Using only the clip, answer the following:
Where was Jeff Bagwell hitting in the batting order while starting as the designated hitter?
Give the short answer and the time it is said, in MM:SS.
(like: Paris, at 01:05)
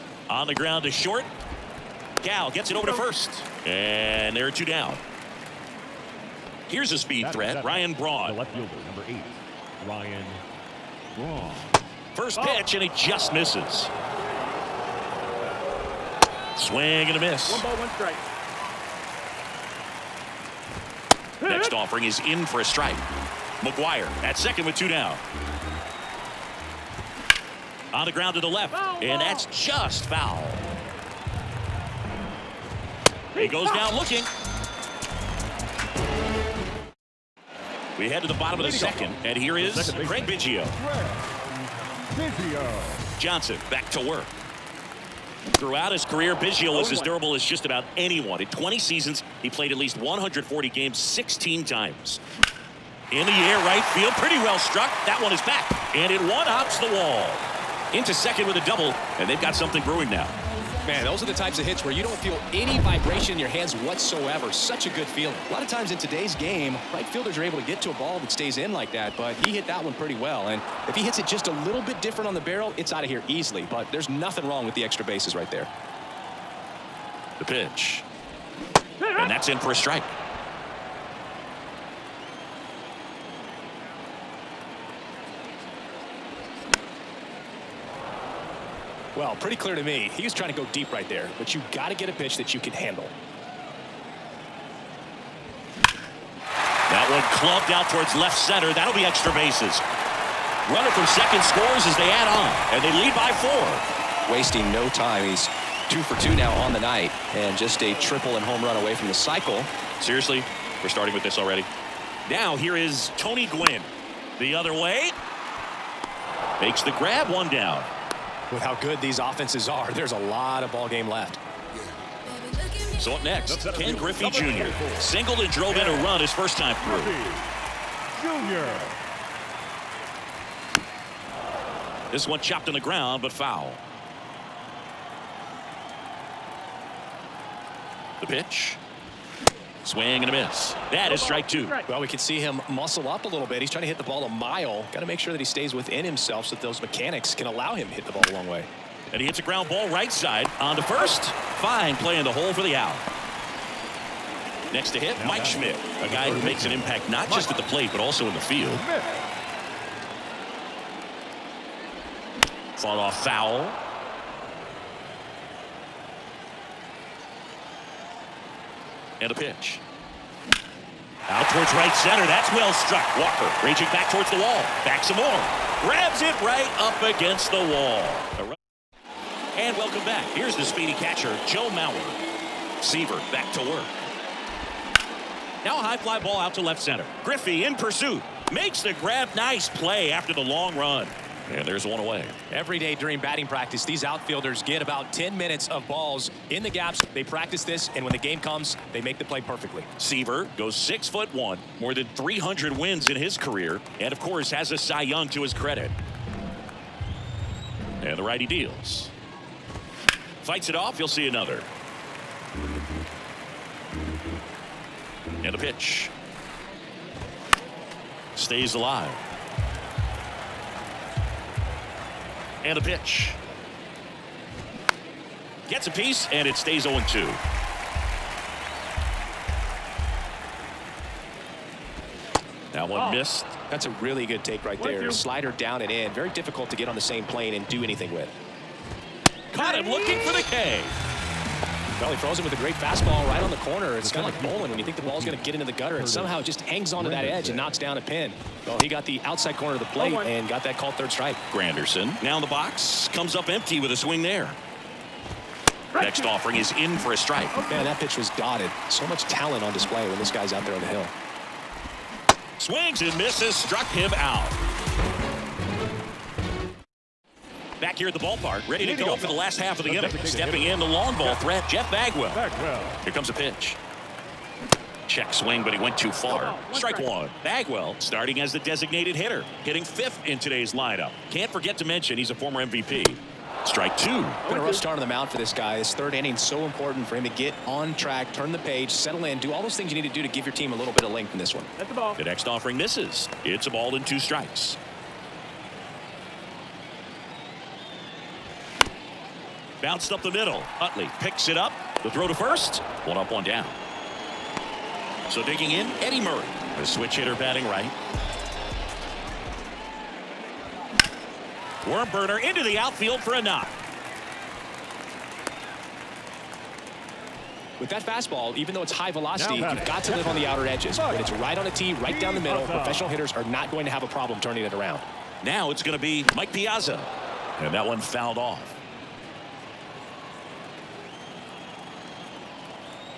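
Fifth, at 04:39.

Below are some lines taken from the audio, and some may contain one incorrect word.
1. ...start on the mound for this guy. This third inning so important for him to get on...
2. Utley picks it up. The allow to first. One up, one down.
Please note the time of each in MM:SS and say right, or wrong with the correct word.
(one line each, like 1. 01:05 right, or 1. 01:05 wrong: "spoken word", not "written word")
1. 04:44 right
2. 05:00 wrong: "throw", not "allow".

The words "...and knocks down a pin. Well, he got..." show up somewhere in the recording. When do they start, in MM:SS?
04:07.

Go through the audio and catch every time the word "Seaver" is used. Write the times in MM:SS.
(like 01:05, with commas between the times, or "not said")
03:02, 03:19.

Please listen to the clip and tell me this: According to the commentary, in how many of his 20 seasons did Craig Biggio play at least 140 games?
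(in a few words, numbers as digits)
16.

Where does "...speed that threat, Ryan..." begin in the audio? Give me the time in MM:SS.
00:06.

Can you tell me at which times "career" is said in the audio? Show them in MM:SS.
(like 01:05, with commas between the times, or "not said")
00:46, 03:23.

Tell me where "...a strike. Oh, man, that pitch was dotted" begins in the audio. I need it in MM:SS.
04:17.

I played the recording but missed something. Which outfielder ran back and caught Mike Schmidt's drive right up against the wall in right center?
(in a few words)
Walker.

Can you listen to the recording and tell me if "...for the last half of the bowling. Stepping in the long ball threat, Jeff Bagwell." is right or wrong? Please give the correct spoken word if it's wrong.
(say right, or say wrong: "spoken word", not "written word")
wrong: "inning", not "bowling".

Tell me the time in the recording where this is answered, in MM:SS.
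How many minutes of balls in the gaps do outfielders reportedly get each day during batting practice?
03:15.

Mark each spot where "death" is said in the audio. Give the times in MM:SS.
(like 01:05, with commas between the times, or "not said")
not said.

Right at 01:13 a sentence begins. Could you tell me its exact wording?
But there's nothing wrong with the extra bases right there.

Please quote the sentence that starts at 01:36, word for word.
That one clubbed out towards left center.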